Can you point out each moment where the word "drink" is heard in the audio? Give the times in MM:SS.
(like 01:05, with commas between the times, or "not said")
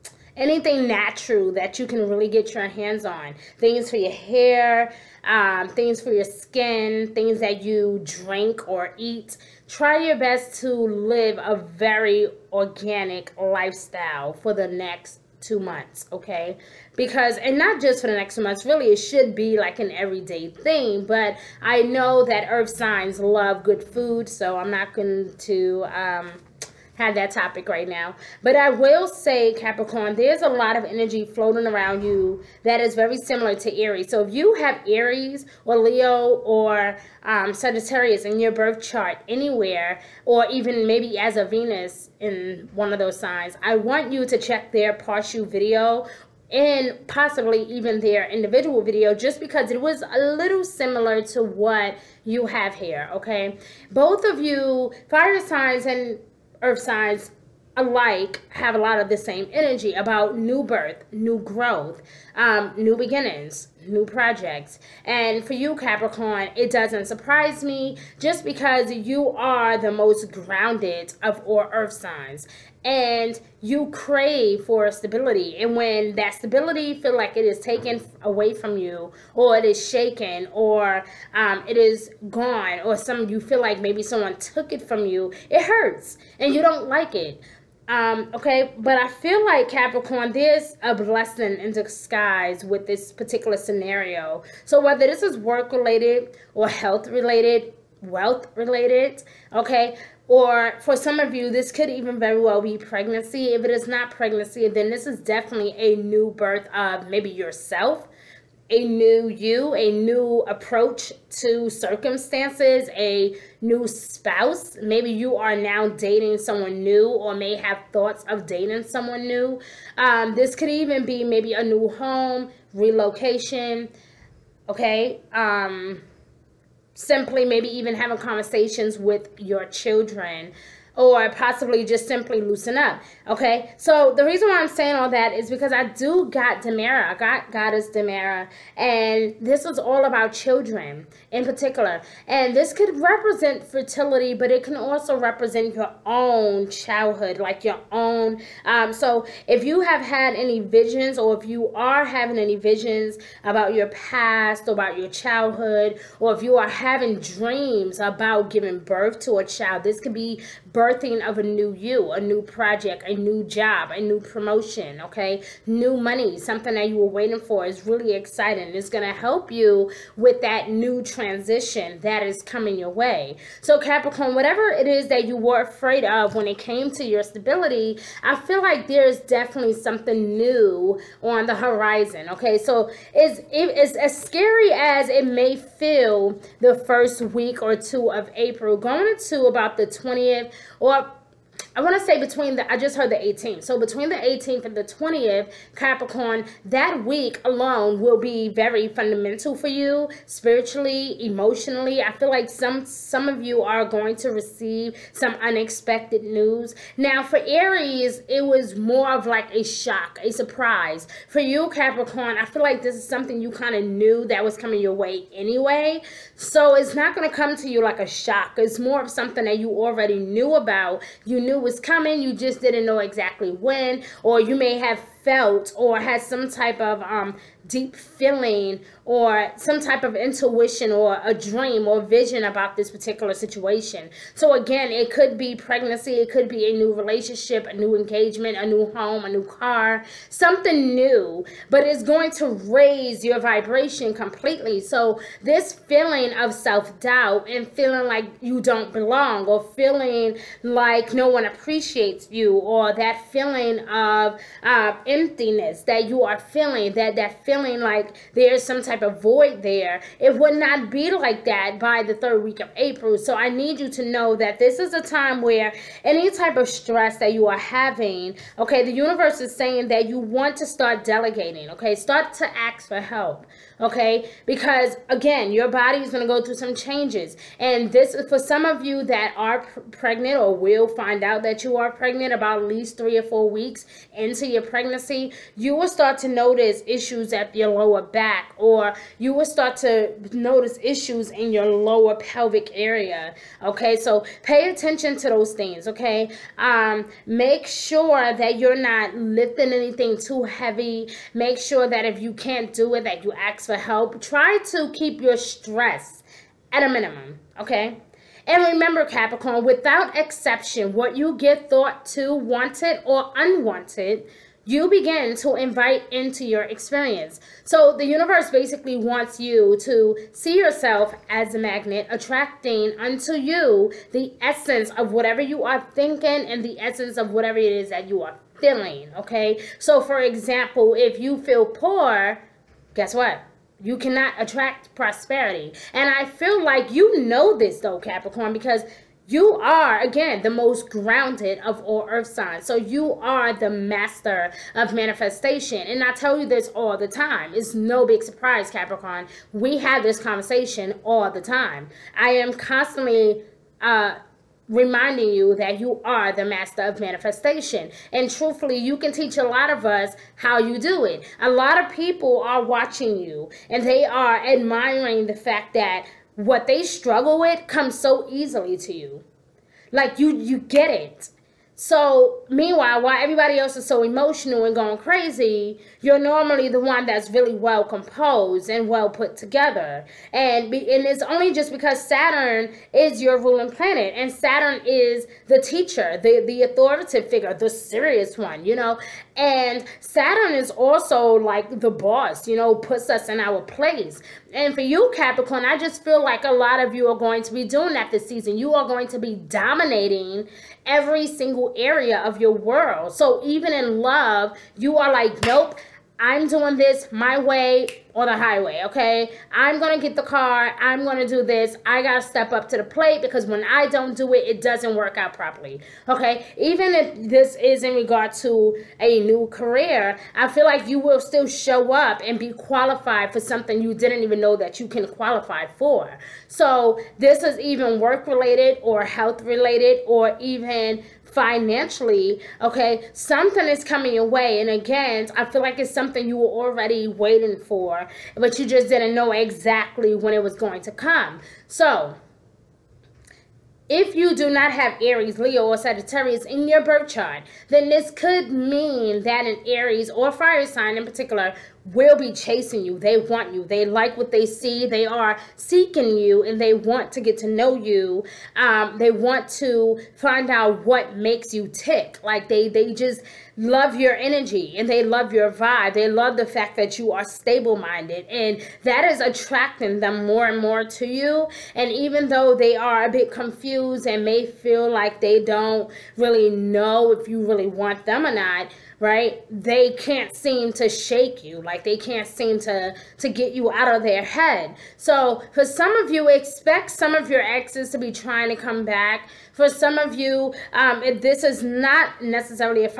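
00:08.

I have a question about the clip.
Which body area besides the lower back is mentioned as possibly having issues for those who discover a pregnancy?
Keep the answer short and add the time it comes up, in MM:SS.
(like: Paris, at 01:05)
lower pelvic area, at 04:51.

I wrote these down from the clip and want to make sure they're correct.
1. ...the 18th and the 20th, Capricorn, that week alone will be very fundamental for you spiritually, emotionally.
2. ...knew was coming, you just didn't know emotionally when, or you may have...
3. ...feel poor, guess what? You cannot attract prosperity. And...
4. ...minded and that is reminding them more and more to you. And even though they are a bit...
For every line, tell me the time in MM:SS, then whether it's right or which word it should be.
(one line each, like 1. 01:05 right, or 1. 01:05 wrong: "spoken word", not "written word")
1. 03:14 right
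2. 03:41 wrong: "exactly", not "emotionally"
3. 05:31 right
4. 07:47 wrong: "attracting", not "reminding".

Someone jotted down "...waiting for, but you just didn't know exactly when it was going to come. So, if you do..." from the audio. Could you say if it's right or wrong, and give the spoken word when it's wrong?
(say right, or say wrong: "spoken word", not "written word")
right.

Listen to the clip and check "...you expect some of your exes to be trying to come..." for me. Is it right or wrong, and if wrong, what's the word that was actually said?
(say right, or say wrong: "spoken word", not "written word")
right.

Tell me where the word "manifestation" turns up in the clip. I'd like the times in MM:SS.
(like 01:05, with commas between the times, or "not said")
05:44, 05:57.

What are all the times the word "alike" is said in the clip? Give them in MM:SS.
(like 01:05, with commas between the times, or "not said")
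00:57.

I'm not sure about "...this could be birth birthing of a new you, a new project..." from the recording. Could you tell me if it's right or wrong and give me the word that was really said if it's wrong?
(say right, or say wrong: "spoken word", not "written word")
right.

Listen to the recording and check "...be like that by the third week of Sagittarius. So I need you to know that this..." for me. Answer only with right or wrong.
wrong.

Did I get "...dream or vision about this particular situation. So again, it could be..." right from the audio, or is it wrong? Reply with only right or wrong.
right.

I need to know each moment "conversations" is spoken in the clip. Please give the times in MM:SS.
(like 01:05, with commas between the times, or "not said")
02:08, 05:50.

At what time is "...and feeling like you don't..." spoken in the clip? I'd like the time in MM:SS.
04:07.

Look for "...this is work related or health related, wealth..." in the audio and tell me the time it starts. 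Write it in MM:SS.
01:35.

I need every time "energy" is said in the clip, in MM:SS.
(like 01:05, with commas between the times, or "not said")
00:30, 00:59, 07:44.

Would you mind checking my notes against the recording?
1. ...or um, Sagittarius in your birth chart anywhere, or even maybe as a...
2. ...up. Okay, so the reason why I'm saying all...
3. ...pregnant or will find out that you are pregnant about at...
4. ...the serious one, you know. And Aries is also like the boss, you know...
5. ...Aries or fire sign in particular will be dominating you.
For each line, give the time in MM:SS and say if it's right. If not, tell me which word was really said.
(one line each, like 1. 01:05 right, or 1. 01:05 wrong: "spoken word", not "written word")
1. 00:36 right
2. 02:12 right
3. 04:39 right
4. 06:27 wrong: "Saturn", not "Aries"
5. 07:29 wrong: "chasing", not "dominating".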